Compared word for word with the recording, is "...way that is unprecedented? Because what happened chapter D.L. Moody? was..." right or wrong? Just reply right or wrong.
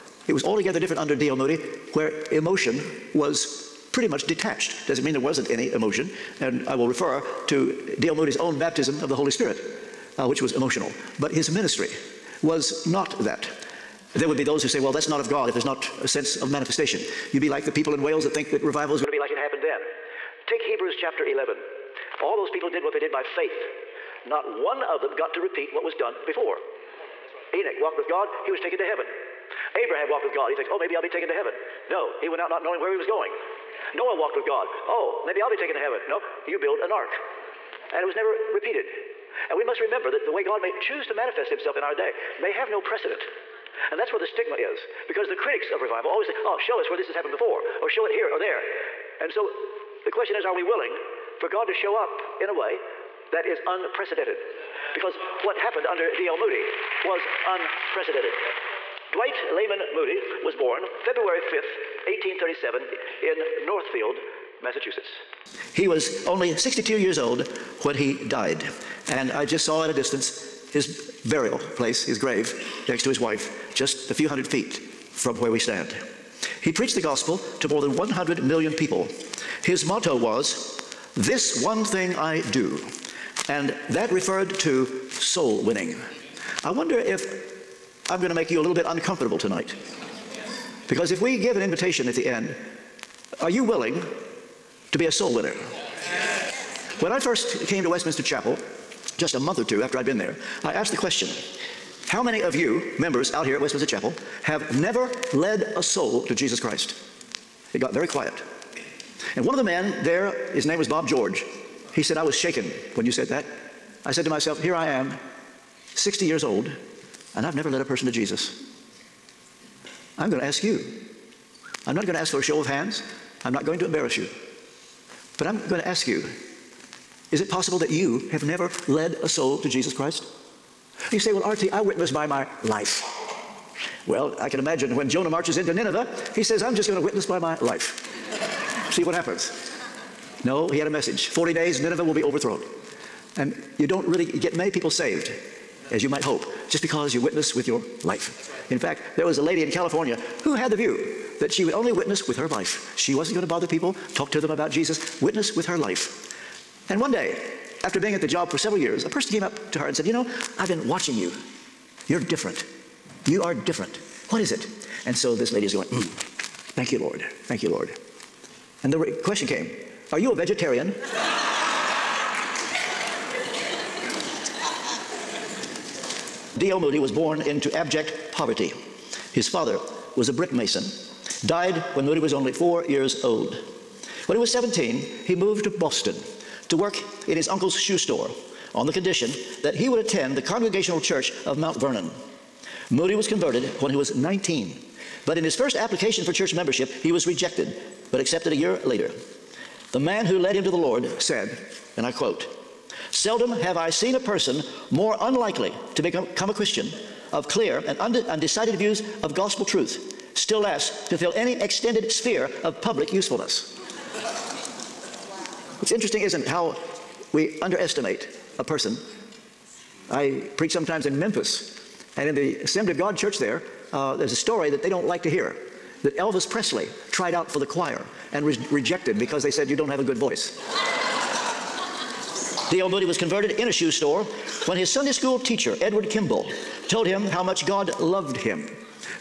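wrong.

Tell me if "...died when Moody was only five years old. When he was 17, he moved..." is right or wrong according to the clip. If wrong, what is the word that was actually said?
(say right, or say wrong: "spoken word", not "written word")
wrong: "four", not "five".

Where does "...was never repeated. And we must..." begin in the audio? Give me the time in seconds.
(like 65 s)
38 s.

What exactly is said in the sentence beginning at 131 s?
You say, Well, RT, I witnessed by my life.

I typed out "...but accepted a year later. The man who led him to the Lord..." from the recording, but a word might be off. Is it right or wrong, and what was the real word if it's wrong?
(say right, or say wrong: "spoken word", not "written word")
right.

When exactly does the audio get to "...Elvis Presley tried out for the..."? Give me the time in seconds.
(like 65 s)
226 s.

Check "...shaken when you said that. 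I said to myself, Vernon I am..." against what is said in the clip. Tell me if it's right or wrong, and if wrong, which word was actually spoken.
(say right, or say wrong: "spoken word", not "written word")
wrong: "Here", not "Vernon".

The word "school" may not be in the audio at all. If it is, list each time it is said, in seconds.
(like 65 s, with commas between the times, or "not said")
235 s.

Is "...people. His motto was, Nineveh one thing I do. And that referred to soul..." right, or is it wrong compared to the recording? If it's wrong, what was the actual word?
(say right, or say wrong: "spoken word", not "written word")
wrong: "This", not "Nineveh".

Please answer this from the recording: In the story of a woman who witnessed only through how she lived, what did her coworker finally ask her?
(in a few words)
A vegetarian.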